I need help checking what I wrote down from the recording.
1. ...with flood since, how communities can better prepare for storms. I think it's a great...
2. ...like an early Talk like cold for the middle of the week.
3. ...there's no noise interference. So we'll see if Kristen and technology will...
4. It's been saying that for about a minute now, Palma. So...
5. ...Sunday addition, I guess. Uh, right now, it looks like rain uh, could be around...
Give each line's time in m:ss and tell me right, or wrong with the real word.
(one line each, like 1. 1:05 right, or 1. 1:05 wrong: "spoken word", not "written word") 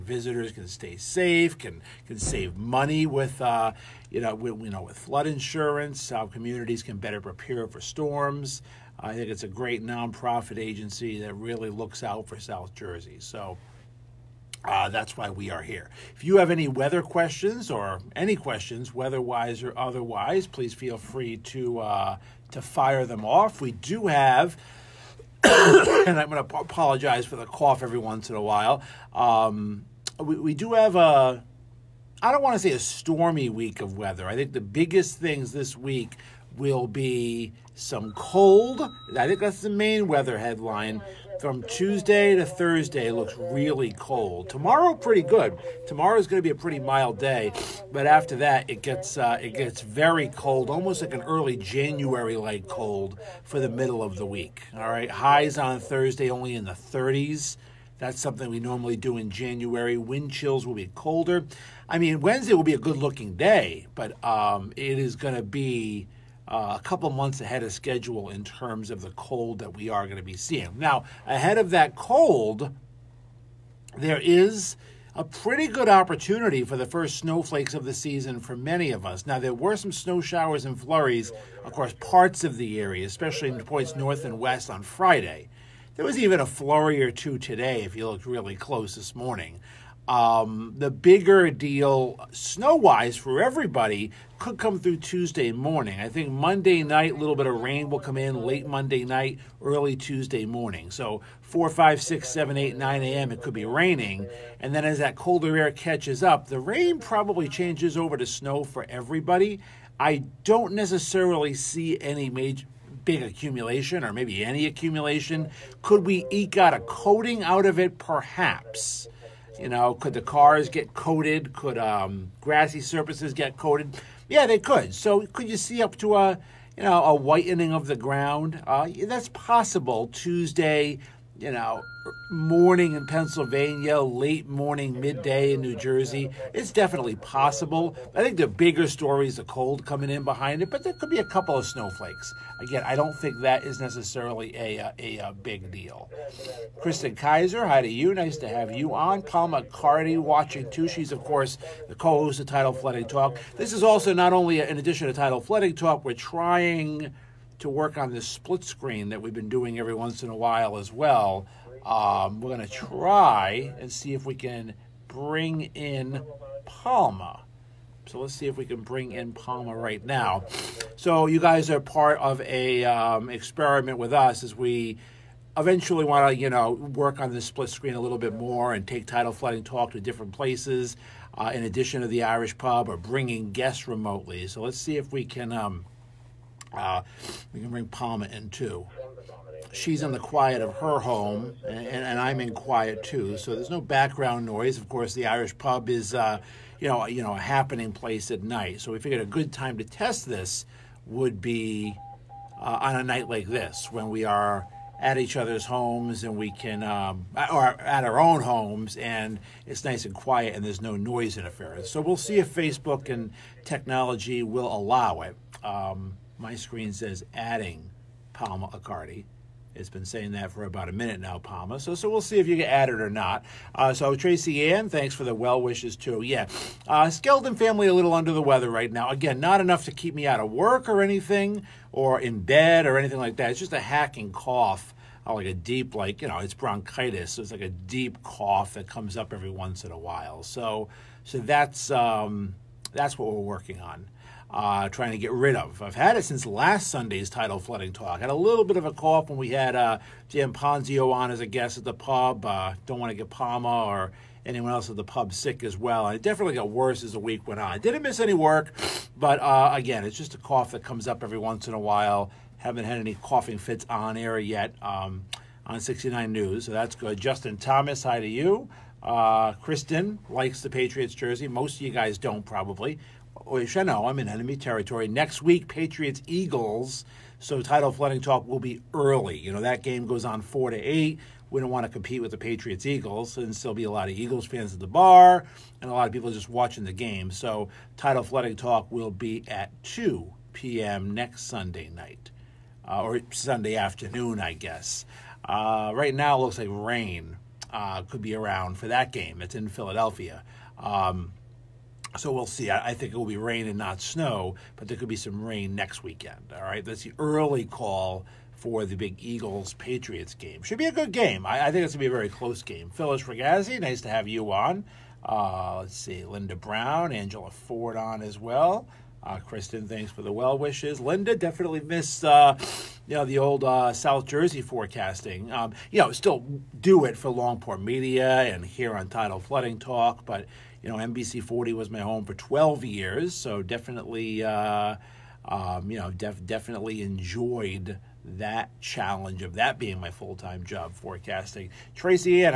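1. 0:04 wrong: "insurance", not "since"
2. 0:51 wrong: "January", not "Talk"
3. 3:30 wrong: "Facebook", not "Kristen"
4. 3:39 right
5. 4:53 wrong: "afternoon", not "addition".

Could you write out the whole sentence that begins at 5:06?
All right, that's the early call for the big Eagles Patriots game.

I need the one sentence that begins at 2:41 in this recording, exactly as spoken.
Um, we're going to try and see if we can bring in Palma.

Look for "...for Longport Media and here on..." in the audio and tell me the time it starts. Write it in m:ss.
5:27.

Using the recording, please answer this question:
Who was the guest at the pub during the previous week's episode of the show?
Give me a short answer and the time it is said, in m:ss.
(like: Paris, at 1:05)
Jim Ponzio, at 4:10.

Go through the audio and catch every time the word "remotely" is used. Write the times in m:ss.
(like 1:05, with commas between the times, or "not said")
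3:03.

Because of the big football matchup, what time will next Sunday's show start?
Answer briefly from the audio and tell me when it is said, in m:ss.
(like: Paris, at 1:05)
2 p.m., at 4:49.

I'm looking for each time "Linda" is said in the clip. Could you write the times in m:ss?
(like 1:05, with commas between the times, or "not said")
5:16, 5:21.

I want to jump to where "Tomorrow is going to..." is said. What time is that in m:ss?
0:45.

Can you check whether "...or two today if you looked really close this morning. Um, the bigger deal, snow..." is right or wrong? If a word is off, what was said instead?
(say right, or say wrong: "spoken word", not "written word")
right.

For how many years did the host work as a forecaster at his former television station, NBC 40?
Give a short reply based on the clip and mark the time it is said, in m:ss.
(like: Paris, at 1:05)
12, at 5:32.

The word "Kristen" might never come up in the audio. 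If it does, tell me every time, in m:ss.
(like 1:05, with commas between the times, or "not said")
2:26, 4:29, 5:19.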